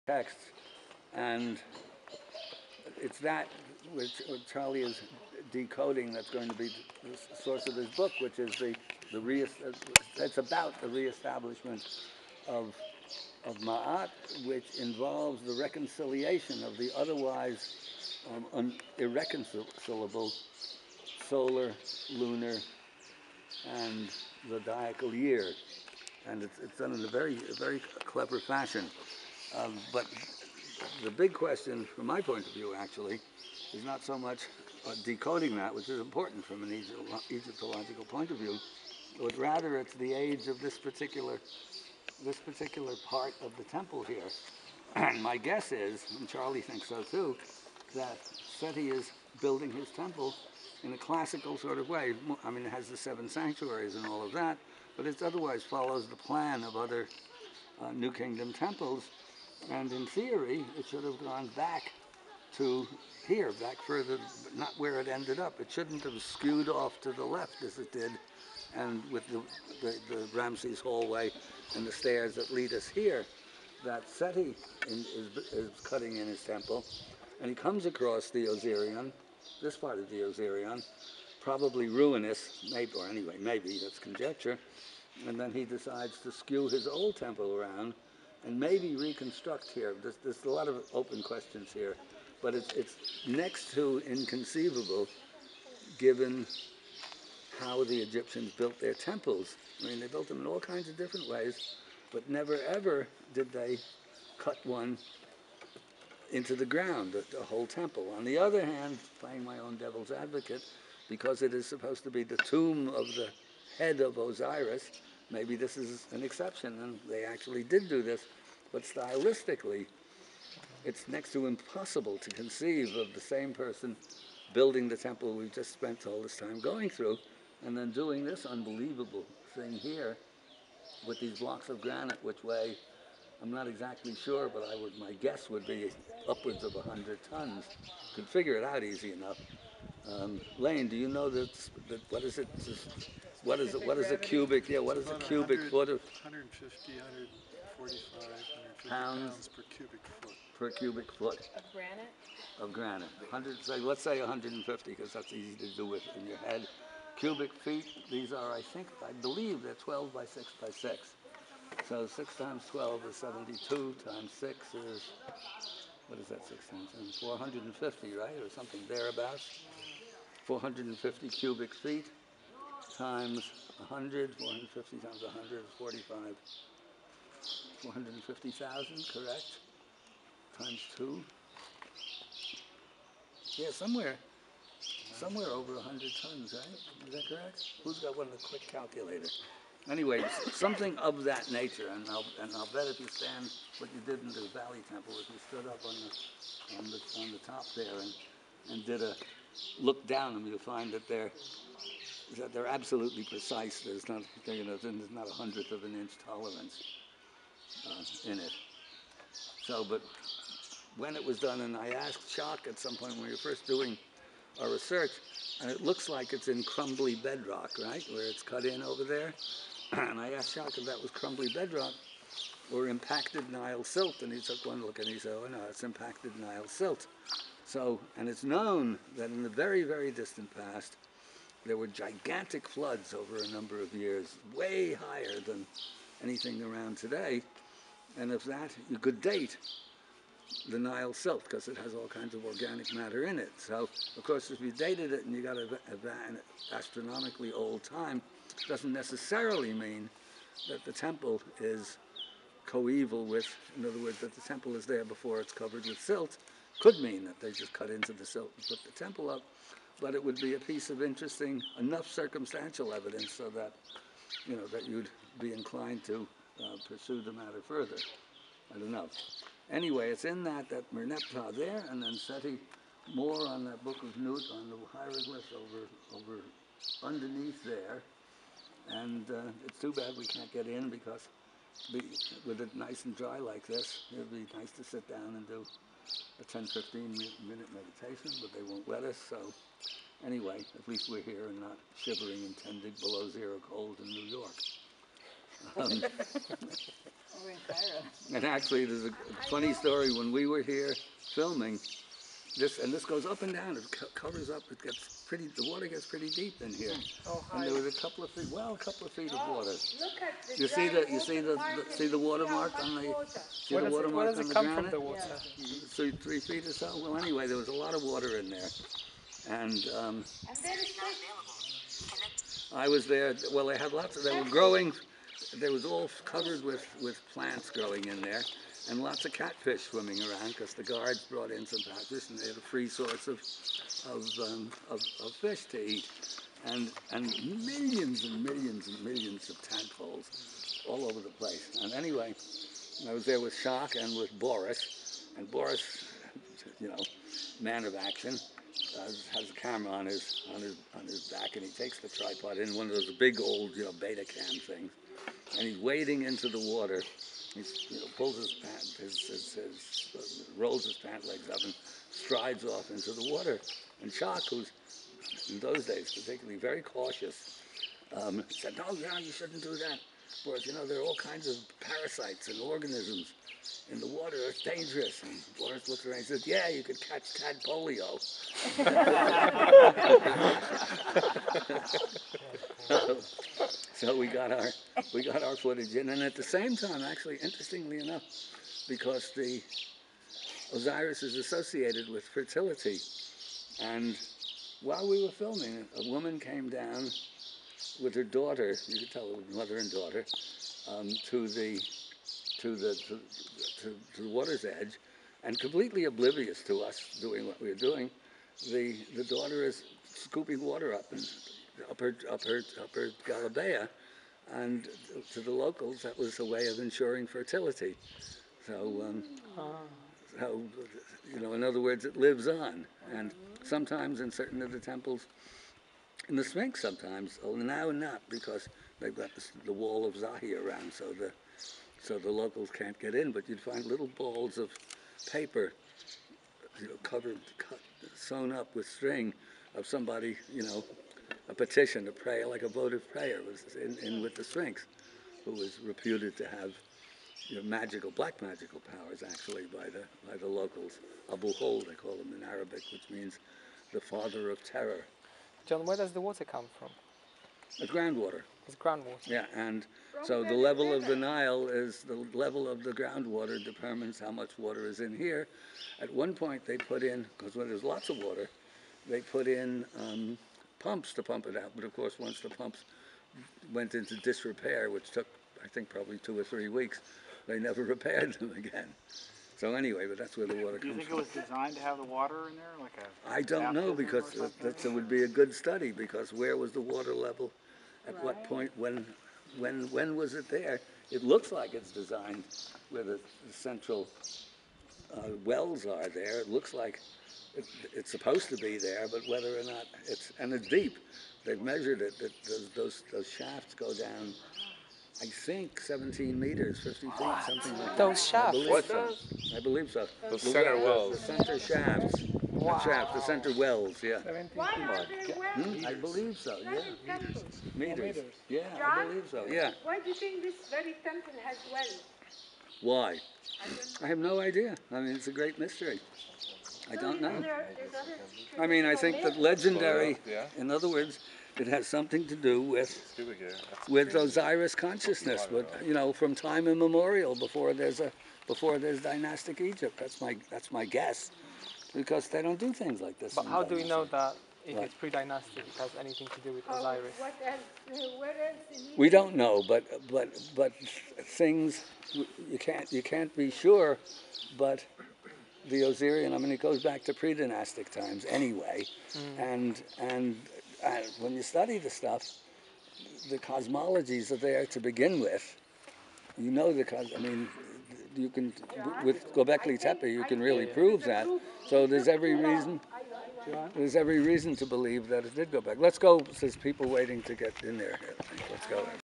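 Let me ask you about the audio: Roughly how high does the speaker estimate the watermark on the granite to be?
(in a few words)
3 feet.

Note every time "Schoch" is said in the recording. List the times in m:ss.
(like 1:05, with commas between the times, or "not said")
5:43, 6:04.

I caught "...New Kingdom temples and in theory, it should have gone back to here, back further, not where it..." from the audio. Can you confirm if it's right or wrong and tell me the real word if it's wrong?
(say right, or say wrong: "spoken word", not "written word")
right.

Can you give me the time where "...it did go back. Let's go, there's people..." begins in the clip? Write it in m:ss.
9:35.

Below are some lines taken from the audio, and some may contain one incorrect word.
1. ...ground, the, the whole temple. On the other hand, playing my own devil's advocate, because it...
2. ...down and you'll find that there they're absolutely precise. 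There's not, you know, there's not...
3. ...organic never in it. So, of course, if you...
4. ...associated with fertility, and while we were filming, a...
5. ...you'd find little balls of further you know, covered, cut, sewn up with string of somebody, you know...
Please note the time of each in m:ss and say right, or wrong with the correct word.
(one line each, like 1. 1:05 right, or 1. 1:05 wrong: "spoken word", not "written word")
1. 1:46 right
2. 3:20 right
3. 4:02 wrong: "matter", not "never"
4. 6:31 right
5. 7:13 wrong: "paper", not "further".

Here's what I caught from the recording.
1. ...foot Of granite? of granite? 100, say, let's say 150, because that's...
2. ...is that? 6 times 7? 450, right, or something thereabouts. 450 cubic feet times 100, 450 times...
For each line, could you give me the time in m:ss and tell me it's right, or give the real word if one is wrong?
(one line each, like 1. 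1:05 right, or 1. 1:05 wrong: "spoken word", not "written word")
1. 2:31 right
2. 2:46 right.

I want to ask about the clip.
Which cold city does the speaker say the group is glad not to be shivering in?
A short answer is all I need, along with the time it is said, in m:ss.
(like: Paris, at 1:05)
New York, at 4:54.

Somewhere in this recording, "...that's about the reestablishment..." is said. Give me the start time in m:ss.
0:10.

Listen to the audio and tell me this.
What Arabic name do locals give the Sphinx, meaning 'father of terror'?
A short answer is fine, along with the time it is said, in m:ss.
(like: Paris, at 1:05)
Abu Hol, at 7:31.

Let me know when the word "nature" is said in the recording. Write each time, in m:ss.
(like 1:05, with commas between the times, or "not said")
3:11.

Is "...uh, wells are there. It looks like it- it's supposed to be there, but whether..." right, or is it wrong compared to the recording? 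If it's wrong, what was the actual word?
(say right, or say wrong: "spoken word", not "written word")
right.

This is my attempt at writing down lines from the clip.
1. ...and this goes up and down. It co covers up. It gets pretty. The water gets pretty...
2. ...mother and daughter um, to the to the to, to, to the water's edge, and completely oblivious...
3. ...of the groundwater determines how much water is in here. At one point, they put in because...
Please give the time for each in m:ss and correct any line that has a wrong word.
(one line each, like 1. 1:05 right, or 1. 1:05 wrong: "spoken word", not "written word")
1. 5:02 right
2. 6:39 right
3. 7:42 right.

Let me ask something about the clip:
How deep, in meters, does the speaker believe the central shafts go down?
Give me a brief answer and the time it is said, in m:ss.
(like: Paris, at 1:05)
17 meters, at 8:25.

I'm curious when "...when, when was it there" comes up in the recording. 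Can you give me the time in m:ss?
8:09.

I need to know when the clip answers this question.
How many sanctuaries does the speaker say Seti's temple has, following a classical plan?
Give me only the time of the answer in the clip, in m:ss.
0:52.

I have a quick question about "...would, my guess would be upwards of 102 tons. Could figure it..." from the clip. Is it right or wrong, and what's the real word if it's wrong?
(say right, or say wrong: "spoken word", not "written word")
wrong: "100", not "102".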